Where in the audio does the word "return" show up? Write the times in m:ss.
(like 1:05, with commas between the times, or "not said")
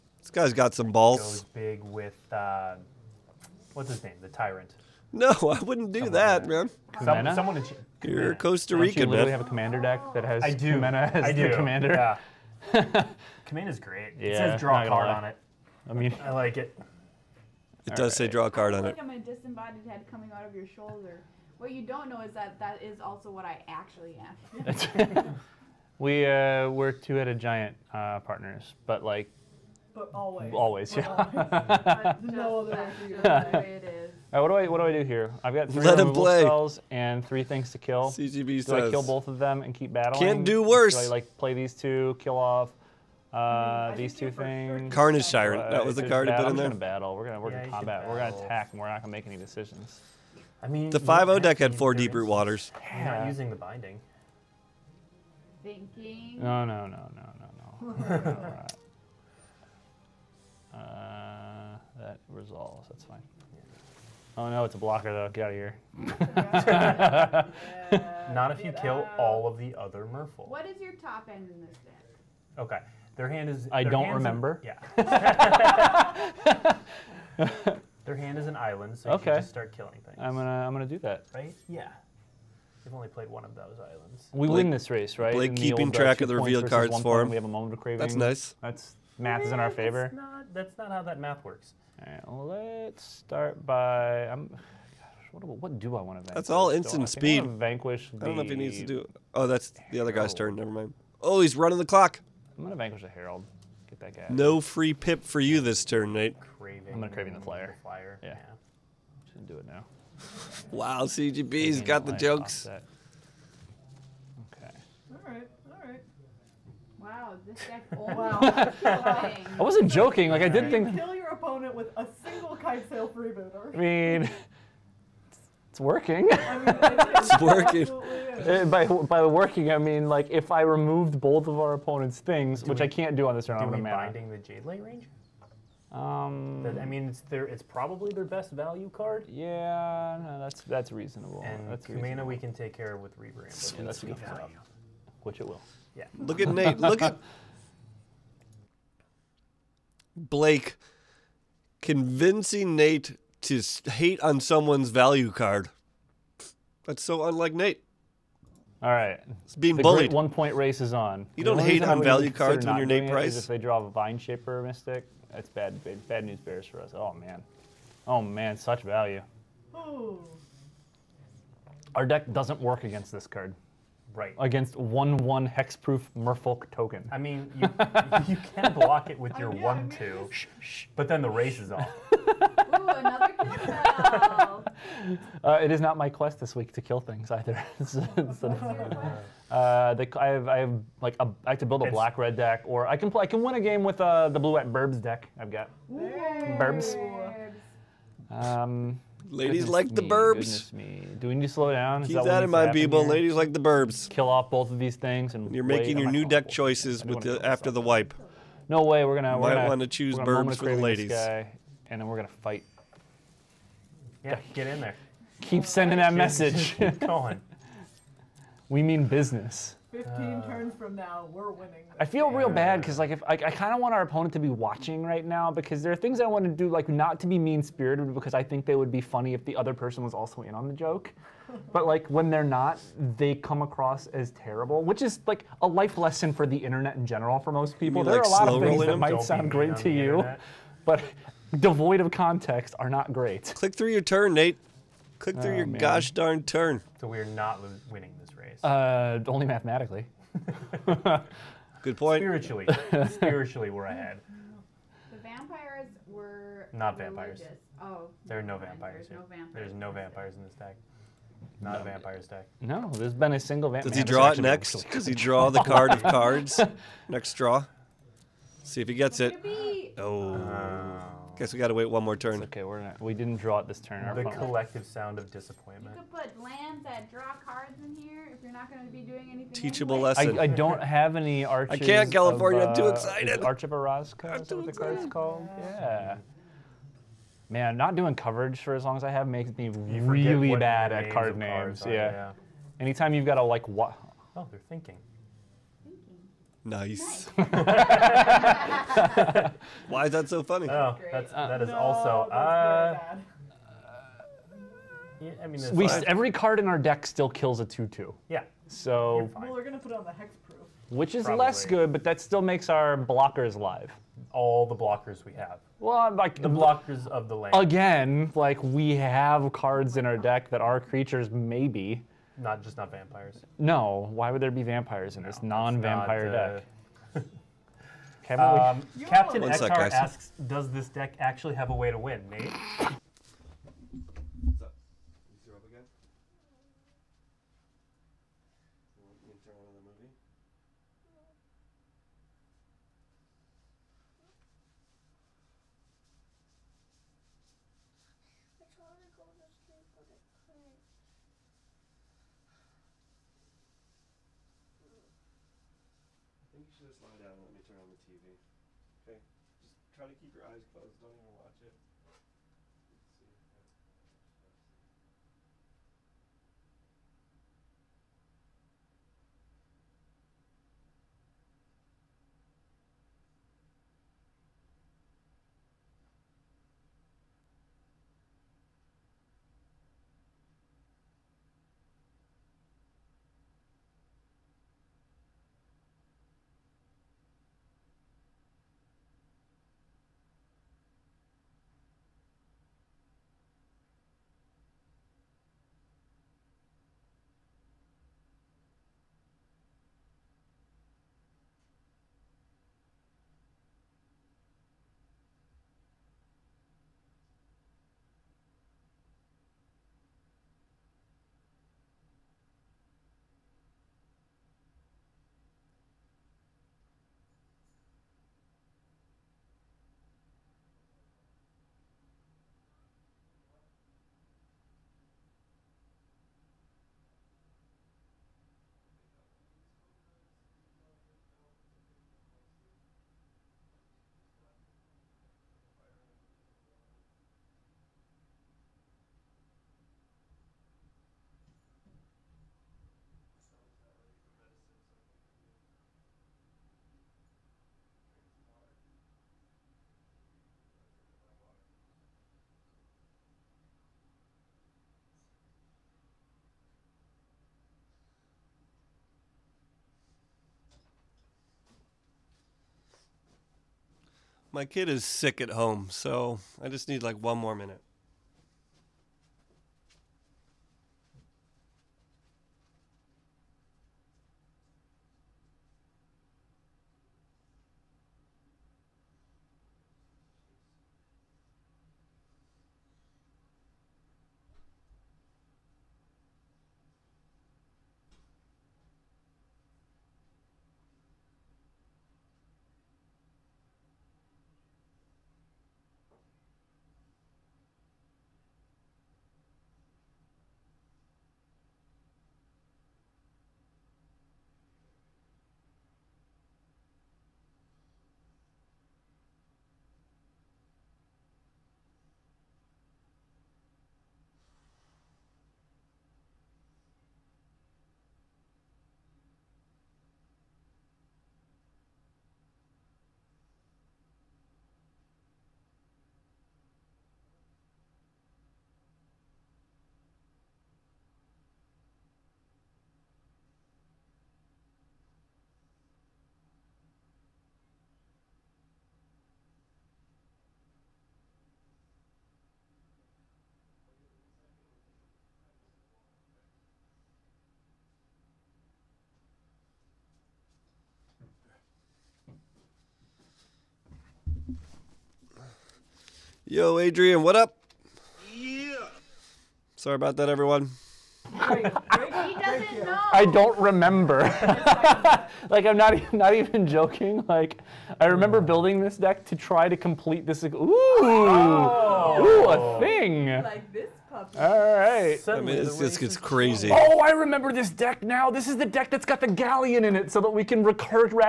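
not said.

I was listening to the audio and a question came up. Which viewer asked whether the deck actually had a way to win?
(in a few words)
Captain Ektar.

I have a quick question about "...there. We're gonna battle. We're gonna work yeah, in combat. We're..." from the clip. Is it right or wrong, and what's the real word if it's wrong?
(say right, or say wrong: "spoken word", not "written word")
right.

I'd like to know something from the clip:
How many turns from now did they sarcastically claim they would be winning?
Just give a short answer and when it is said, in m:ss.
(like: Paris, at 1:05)
15, at 3:39.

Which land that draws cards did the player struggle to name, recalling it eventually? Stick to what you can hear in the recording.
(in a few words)
Arch of Orazca.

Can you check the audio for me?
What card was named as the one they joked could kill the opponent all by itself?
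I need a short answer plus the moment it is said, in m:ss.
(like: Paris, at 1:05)
Kite Sail Freebooter, at 2:02.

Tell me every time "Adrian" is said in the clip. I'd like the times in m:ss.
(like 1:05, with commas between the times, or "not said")
9:16.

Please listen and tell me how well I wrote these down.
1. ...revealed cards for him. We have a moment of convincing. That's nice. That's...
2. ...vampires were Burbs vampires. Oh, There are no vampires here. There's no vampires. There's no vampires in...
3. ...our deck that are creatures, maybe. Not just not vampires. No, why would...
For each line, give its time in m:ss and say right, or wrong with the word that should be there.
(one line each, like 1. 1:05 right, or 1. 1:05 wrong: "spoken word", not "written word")
1. 1:26 wrong: "craving", not "convincing"
2. 4:15 wrong: "Not", not "Burbs"
3. 5:20 right.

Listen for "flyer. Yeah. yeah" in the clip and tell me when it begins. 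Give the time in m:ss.
1:47.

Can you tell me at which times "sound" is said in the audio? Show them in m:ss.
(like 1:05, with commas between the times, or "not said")
3:59, 4:34.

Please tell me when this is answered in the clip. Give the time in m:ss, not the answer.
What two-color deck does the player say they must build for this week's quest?
3:11.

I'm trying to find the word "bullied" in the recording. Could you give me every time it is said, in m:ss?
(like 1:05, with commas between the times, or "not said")
2:39.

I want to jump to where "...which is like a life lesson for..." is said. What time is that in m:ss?
3:54.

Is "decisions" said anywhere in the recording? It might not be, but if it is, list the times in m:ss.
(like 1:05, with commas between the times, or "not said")
0:49.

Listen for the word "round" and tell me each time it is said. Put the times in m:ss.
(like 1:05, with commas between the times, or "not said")
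2:13.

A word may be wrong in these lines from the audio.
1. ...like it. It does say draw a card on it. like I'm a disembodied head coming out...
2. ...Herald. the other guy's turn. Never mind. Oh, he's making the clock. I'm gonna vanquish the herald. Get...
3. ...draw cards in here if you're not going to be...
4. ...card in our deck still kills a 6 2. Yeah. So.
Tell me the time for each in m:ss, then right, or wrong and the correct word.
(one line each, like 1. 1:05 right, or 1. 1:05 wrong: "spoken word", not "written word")
1. 0:16 right
2. 1:39 wrong: "running", not "making"
3. 4:37 right
4. 5:06 wrong: "2", not "6".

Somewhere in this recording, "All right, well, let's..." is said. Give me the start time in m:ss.
1:31.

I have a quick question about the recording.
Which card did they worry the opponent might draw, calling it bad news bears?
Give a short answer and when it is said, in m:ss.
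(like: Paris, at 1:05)
Vine Shaper Mystic, at 2:43.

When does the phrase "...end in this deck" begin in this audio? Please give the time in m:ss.
1:11.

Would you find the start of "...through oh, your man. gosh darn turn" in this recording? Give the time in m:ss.
4:05.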